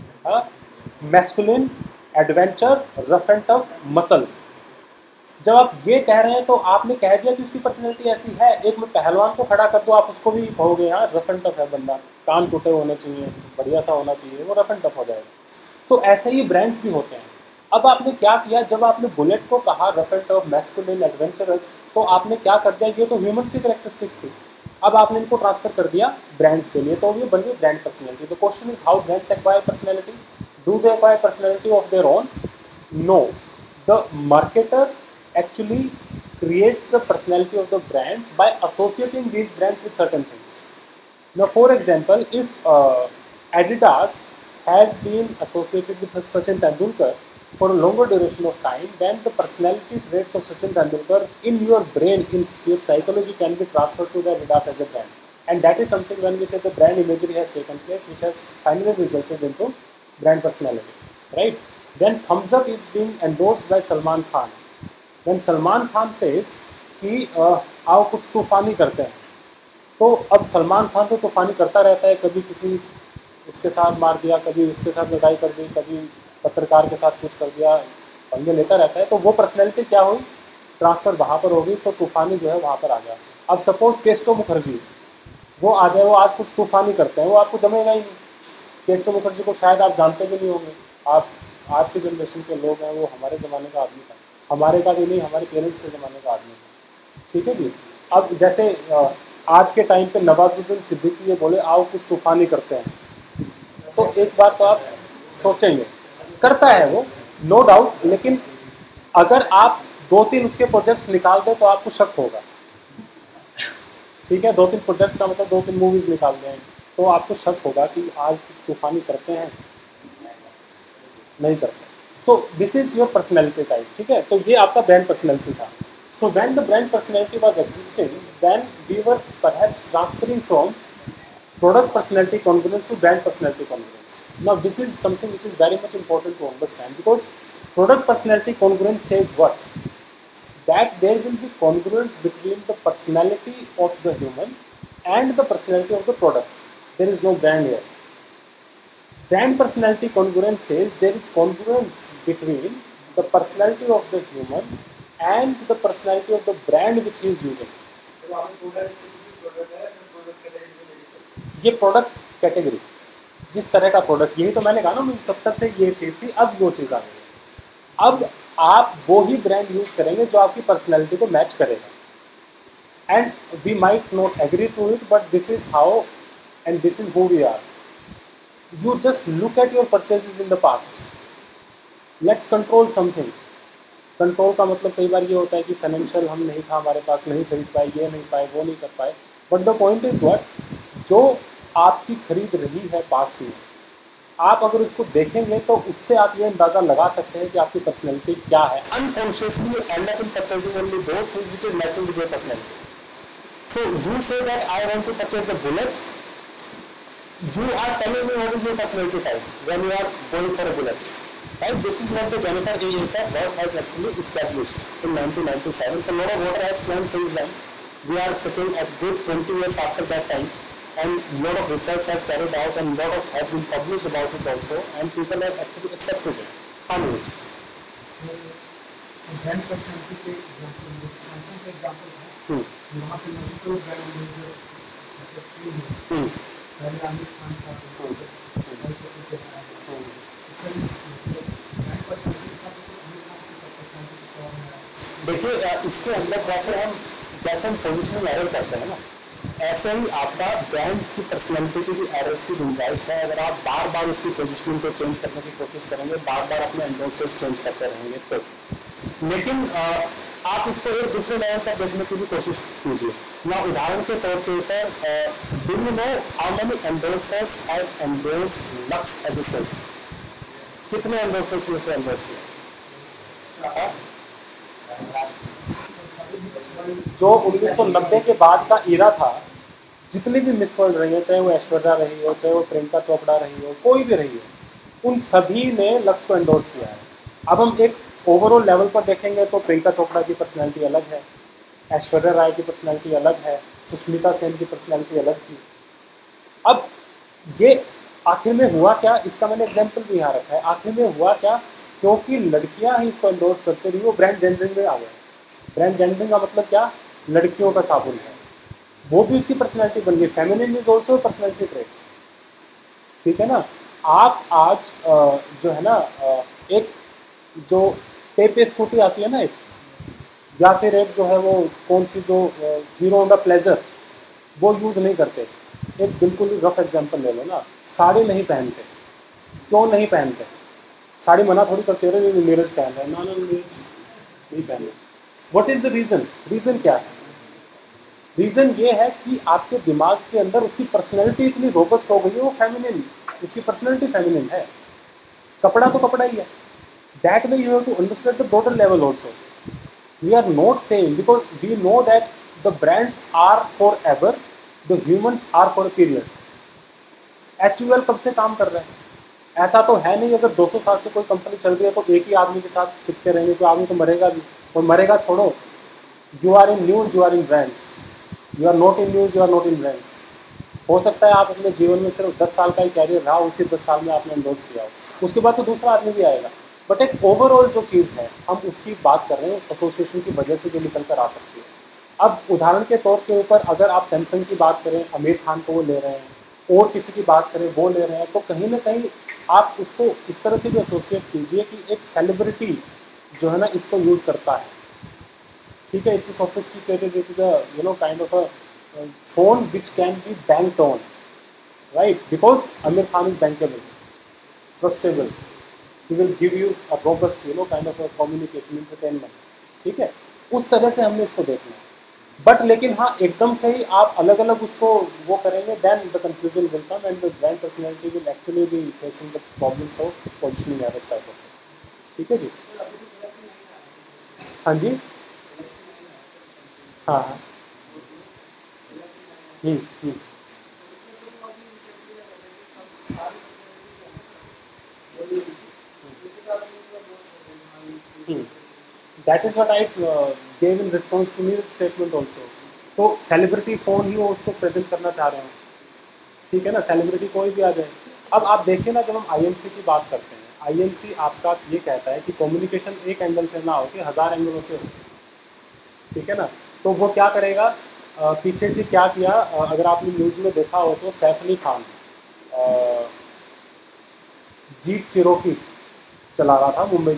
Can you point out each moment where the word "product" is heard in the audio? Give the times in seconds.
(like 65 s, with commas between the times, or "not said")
137 s, 146 s, 161 s.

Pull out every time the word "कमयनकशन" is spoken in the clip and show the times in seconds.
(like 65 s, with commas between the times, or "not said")
408 s, 452 s.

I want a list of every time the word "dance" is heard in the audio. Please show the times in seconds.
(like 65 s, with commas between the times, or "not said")
not said.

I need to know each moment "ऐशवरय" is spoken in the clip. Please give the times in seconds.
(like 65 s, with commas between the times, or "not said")
281 s, 291 s.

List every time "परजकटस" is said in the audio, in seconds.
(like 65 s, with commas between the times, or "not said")
110 s, 114 s.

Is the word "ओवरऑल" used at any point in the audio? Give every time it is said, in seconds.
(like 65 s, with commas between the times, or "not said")
288 s, 377 s.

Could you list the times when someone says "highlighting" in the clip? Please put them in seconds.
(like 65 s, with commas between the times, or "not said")
not said.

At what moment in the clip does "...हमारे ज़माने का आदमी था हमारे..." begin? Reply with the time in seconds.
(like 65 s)
93 s.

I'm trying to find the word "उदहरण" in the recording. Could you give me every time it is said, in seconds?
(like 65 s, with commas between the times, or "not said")
263 s, 382 s.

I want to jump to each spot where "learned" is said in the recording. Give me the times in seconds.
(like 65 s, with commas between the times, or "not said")
not said.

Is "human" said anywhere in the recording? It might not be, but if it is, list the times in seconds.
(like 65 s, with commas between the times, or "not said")
144 s, 154 s.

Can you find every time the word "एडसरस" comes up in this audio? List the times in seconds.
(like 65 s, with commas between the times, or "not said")
266 s, 271 s.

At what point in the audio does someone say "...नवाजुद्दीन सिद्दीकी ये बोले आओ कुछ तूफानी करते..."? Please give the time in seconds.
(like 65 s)
100 s.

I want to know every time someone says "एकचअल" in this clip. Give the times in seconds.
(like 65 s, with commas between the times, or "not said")
35 s, 213 s, 418 s.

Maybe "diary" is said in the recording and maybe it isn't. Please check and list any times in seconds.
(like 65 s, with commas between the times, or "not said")
not said.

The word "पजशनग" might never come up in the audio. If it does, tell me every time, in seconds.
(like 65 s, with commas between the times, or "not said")
247 s, 254 s, 420 s.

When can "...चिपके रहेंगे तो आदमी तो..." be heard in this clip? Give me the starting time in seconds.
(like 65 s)
363 s.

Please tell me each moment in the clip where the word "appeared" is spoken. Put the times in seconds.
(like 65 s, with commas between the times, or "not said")
not said.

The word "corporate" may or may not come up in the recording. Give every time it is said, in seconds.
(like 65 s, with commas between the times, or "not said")
not said.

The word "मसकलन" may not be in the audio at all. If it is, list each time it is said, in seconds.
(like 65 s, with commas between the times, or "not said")
0 s, 20 s.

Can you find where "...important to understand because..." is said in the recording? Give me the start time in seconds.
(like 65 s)
135 s.